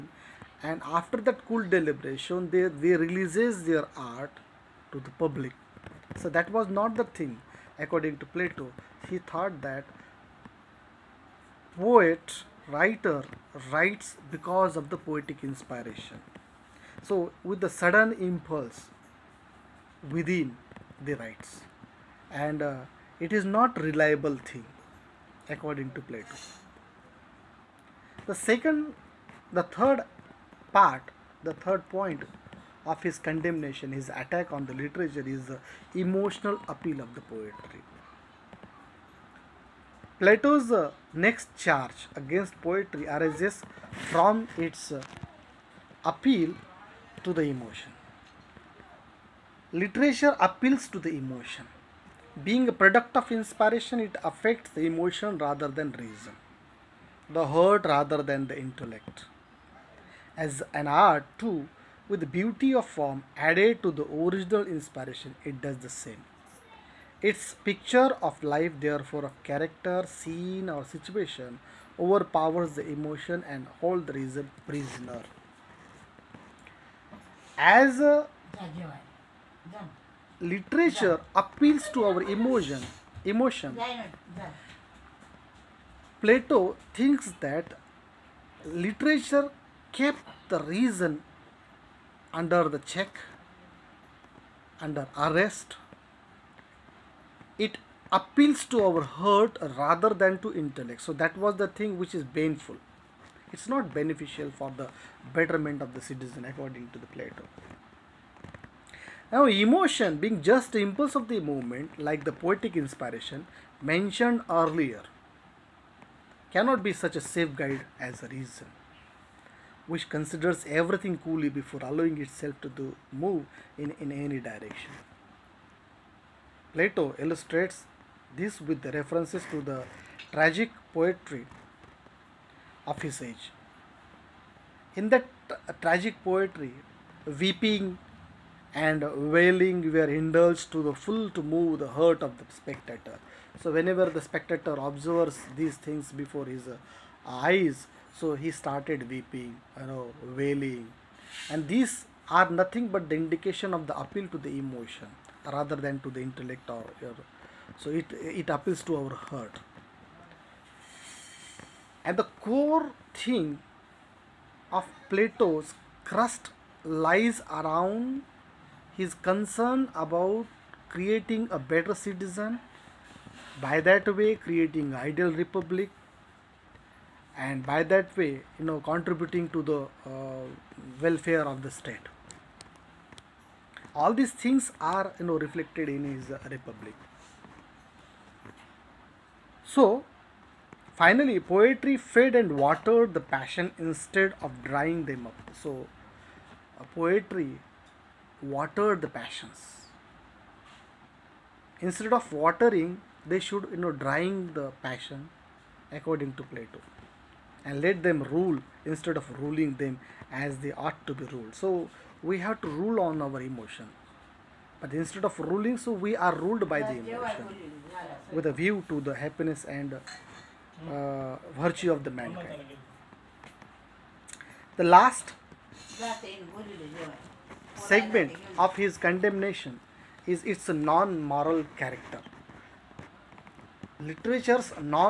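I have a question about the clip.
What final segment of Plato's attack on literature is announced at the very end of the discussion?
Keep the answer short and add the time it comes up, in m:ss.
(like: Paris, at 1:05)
its non-moral character, at 3:50.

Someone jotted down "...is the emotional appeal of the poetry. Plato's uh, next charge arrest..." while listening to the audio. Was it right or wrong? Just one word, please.
wrong.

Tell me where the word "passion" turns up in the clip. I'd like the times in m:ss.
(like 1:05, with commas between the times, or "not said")
3:13, 3:19, 3:24.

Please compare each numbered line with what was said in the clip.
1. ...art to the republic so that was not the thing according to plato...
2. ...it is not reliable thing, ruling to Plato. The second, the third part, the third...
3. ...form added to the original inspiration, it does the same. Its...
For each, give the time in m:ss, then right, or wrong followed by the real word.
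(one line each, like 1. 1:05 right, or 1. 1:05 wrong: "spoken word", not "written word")
1. 0:03 wrong: "public", not "republic"
2. 0:23 wrong: "according", not "ruling"
3. 1:02 right.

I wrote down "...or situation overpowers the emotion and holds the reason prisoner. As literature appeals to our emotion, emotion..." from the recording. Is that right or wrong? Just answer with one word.
right.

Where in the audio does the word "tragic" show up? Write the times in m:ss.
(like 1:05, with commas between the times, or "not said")
2:10, 2:15.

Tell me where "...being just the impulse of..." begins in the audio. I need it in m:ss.
1:50.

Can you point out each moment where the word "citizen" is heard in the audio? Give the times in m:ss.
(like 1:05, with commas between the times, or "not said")
1:46, 2:52.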